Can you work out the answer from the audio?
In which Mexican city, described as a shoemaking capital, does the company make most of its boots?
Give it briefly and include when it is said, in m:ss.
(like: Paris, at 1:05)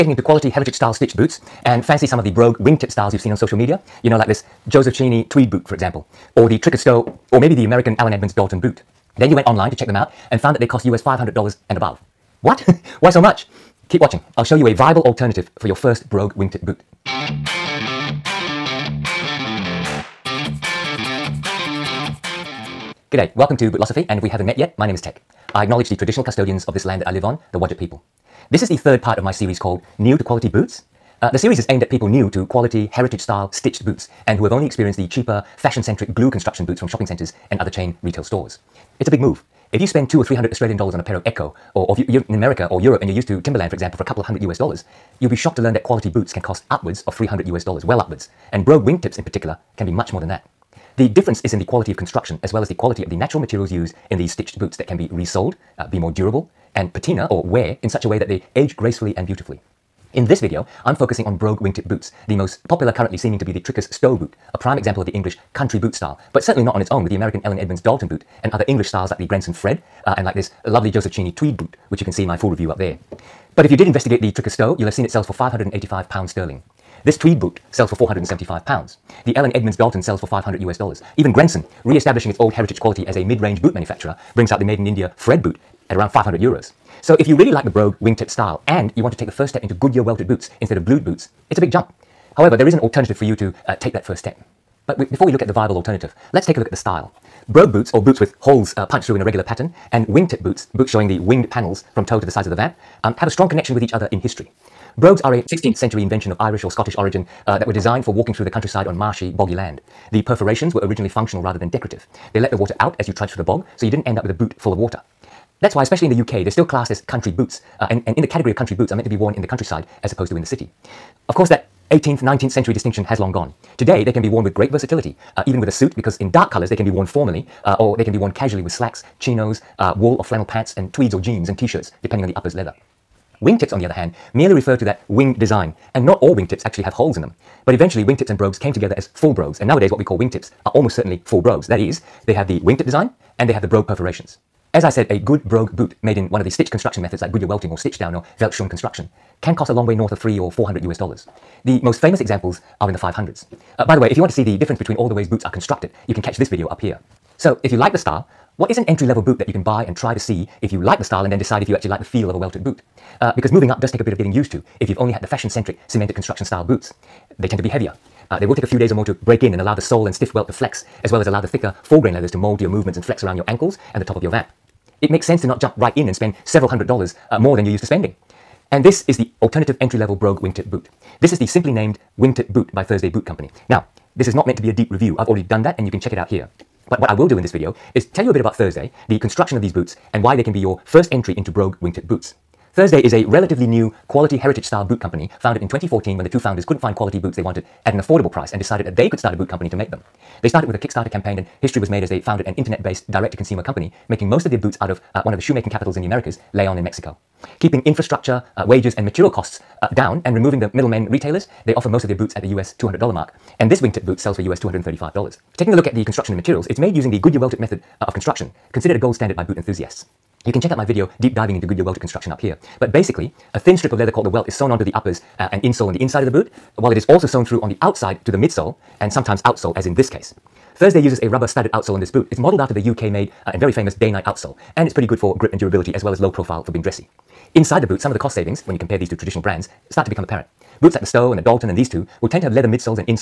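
Leon, at 3:26.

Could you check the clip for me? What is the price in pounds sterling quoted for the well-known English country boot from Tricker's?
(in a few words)
£585.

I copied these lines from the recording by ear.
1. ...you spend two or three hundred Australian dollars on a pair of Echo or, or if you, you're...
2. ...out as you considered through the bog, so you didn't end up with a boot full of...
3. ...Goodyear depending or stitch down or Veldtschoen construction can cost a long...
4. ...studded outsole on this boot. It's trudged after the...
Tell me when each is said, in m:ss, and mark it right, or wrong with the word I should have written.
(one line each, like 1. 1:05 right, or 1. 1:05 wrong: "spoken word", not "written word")
1. 0:39 right
2. 1:52 wrong: "trudged", not "considered"
3. 2:27 wrong: "welting", not "depending"
4. 3:51 wrong: "modeled", not "trudged".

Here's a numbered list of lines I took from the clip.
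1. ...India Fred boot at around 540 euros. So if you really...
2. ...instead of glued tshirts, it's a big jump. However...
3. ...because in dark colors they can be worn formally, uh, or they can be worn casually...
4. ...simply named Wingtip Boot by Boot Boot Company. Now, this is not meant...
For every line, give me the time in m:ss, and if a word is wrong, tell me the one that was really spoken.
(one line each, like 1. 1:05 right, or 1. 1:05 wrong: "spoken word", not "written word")
1. 1:24 wrong: "500", not "540"
2. 1:30 wrong: "boots", not "tshirts"
3. 2:05 right
4. 3:01 wrong: "Thursday", not "Boot".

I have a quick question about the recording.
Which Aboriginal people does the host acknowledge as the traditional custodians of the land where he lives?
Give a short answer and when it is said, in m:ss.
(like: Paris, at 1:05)
Wadjuk, at 0:27.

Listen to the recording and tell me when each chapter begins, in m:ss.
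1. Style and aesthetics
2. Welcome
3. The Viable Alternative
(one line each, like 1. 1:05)
1. 1:34
2. 0:22
3. 2:24.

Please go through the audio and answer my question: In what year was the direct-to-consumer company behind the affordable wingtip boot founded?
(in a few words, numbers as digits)
2014.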